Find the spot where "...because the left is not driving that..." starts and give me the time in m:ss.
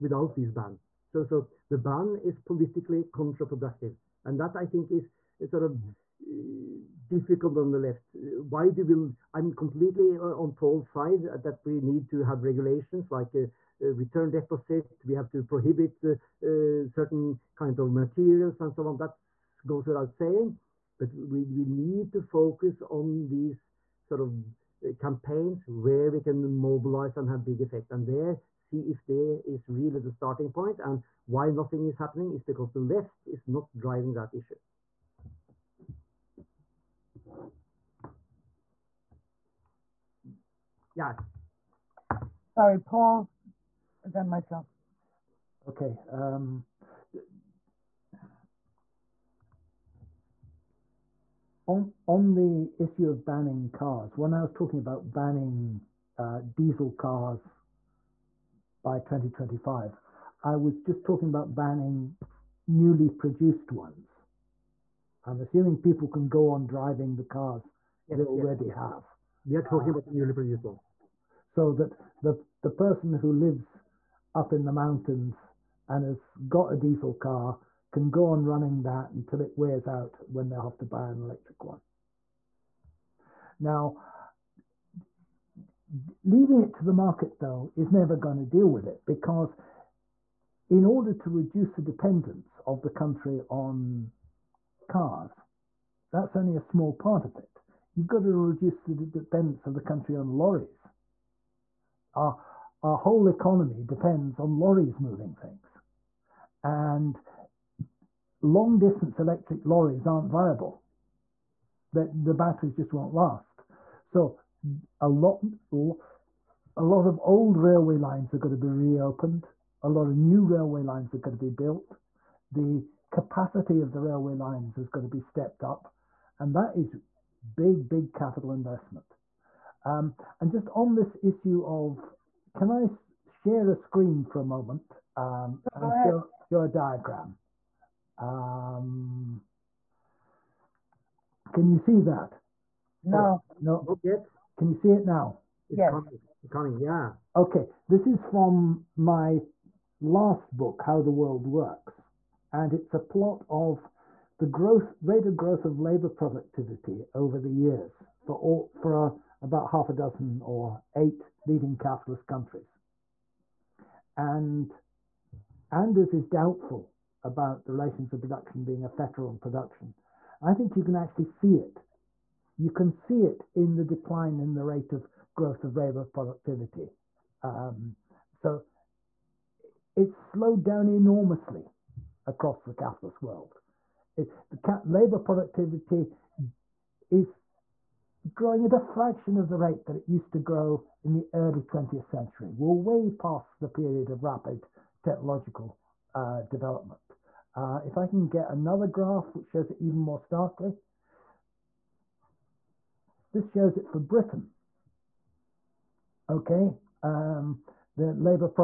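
0:32.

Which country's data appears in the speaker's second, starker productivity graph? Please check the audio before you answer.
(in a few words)
Britain.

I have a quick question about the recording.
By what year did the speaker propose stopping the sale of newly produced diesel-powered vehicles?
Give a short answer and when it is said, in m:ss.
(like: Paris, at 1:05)
2025, at 0:58.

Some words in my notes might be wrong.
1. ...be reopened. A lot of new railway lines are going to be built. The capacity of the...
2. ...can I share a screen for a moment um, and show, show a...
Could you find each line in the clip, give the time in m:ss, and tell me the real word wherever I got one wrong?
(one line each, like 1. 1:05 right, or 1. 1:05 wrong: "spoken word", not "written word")
1. 1:58 right
2. 2:12 right.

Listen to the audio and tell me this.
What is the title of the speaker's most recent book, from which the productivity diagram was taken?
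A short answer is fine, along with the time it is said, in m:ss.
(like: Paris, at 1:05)
How the World Works, at 2:30.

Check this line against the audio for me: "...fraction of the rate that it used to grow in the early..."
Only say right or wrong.
right.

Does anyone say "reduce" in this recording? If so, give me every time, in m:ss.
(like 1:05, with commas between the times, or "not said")
1:31, 1:38.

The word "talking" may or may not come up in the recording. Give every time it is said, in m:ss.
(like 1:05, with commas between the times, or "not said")
0:54, 1:01, 1:09.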